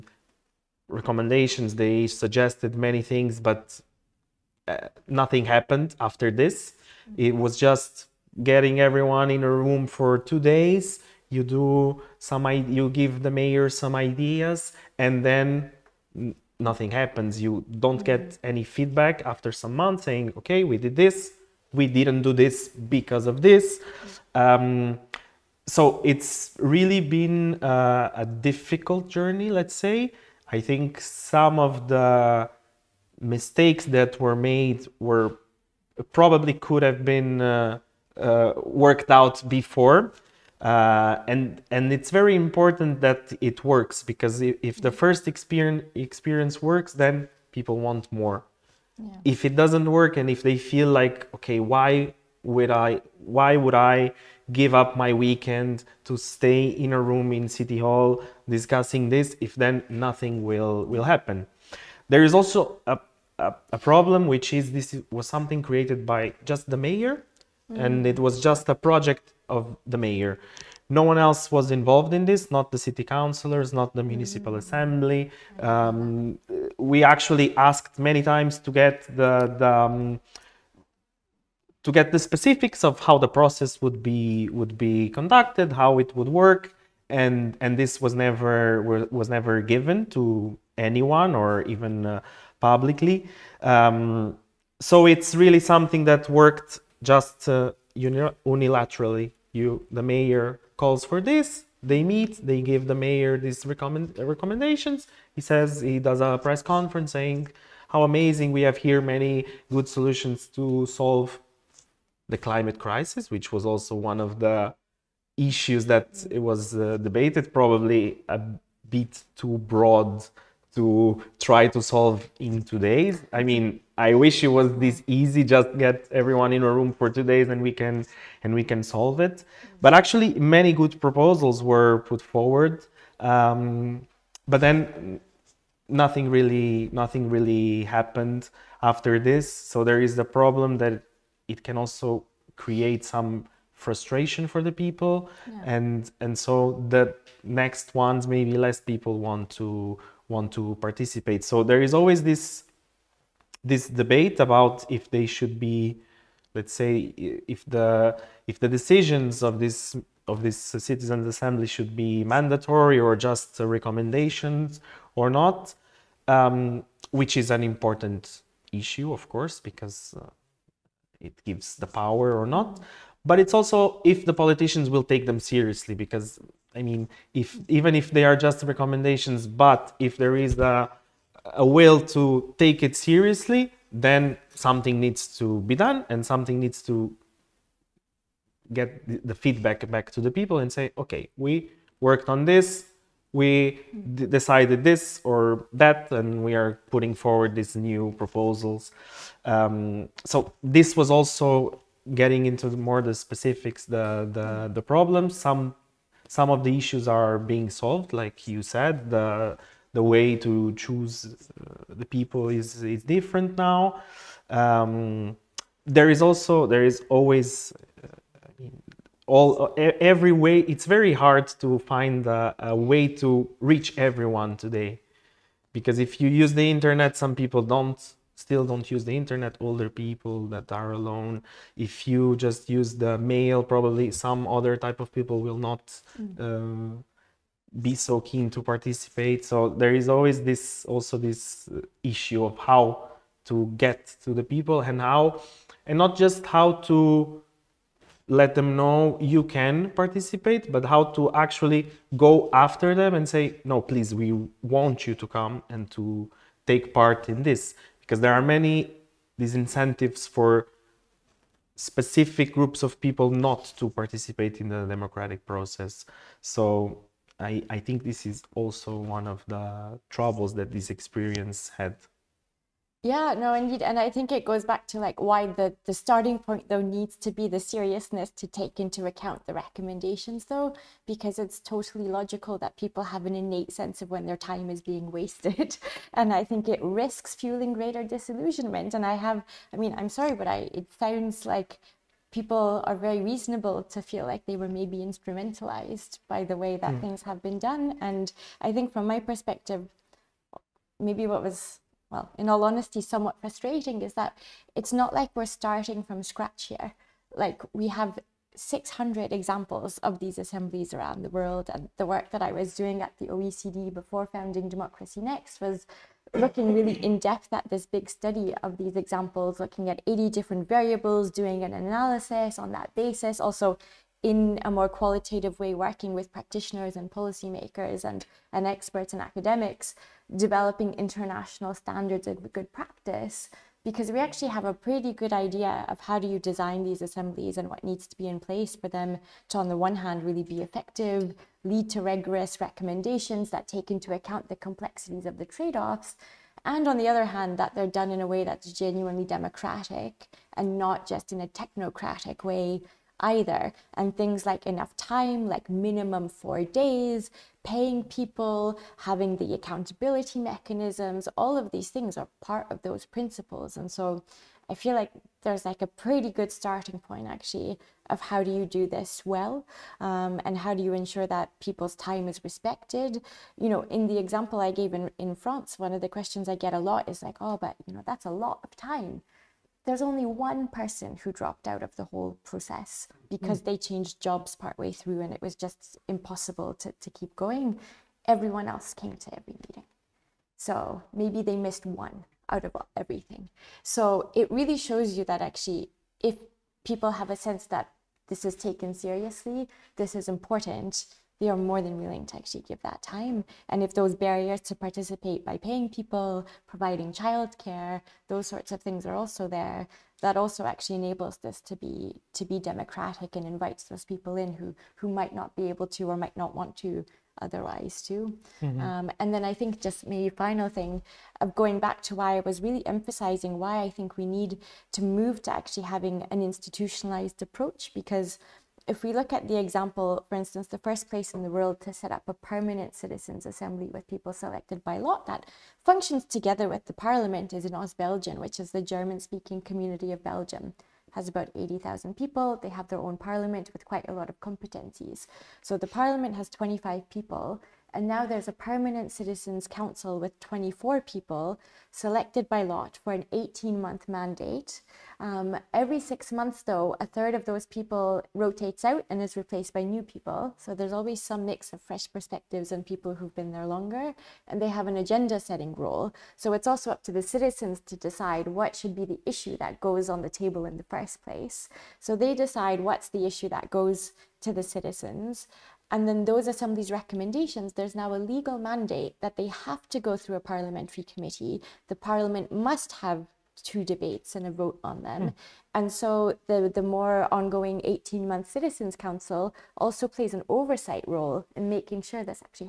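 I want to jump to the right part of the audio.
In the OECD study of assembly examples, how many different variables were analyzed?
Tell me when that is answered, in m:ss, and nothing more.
5:20.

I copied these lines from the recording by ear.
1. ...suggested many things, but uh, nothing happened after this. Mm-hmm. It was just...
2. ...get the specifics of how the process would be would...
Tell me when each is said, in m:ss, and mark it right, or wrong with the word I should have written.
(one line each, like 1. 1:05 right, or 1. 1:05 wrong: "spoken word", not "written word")
1. 0:02 right
2. 1:21 right.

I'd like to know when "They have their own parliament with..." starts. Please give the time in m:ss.
7:22.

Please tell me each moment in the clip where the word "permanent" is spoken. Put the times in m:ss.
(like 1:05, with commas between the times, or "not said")
7:12, 7:28.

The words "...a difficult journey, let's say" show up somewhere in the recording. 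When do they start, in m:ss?
0:28.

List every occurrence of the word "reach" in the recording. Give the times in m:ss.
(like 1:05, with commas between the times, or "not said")
3:43.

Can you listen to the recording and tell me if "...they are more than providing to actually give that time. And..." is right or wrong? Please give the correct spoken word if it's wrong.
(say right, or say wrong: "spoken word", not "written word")
wrong: "willing", not "providing".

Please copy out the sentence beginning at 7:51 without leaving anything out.
So they decide what's the issue that goes to the citizens.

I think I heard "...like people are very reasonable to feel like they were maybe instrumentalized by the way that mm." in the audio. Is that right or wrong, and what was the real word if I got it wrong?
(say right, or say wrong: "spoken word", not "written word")
right.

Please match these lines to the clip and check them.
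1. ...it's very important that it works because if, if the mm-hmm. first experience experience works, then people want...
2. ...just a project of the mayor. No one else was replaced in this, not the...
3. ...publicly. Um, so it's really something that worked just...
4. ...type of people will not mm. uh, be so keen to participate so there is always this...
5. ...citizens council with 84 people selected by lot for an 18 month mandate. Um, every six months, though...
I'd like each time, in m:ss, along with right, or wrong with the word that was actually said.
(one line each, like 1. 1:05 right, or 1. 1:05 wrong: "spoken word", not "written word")
1. 0:41 right
2. 1:08 wrong: "involved", not "replaced"
3. 1:32 right
4. 3:54 right
5. 7:29 wrong: "24", not "84".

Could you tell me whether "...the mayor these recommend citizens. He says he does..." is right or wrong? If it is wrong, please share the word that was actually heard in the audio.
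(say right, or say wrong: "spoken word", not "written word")
wrong: "recommendations", not "citizens".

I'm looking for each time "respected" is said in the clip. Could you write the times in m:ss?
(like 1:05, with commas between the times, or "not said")
6:12.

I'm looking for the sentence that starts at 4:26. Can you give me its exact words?
So I, I think this is also one of the troubles that this experience had.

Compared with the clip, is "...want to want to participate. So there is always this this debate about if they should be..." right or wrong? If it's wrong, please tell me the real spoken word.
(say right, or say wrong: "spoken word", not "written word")
right.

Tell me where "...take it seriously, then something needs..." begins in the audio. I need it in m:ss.
3:02.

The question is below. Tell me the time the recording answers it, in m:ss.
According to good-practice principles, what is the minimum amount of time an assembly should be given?
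5:55.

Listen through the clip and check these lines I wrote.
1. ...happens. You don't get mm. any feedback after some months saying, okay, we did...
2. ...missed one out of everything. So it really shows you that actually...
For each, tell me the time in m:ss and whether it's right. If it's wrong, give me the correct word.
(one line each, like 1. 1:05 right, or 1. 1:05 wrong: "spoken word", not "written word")
1. 0:16 right
2. 6:31 right.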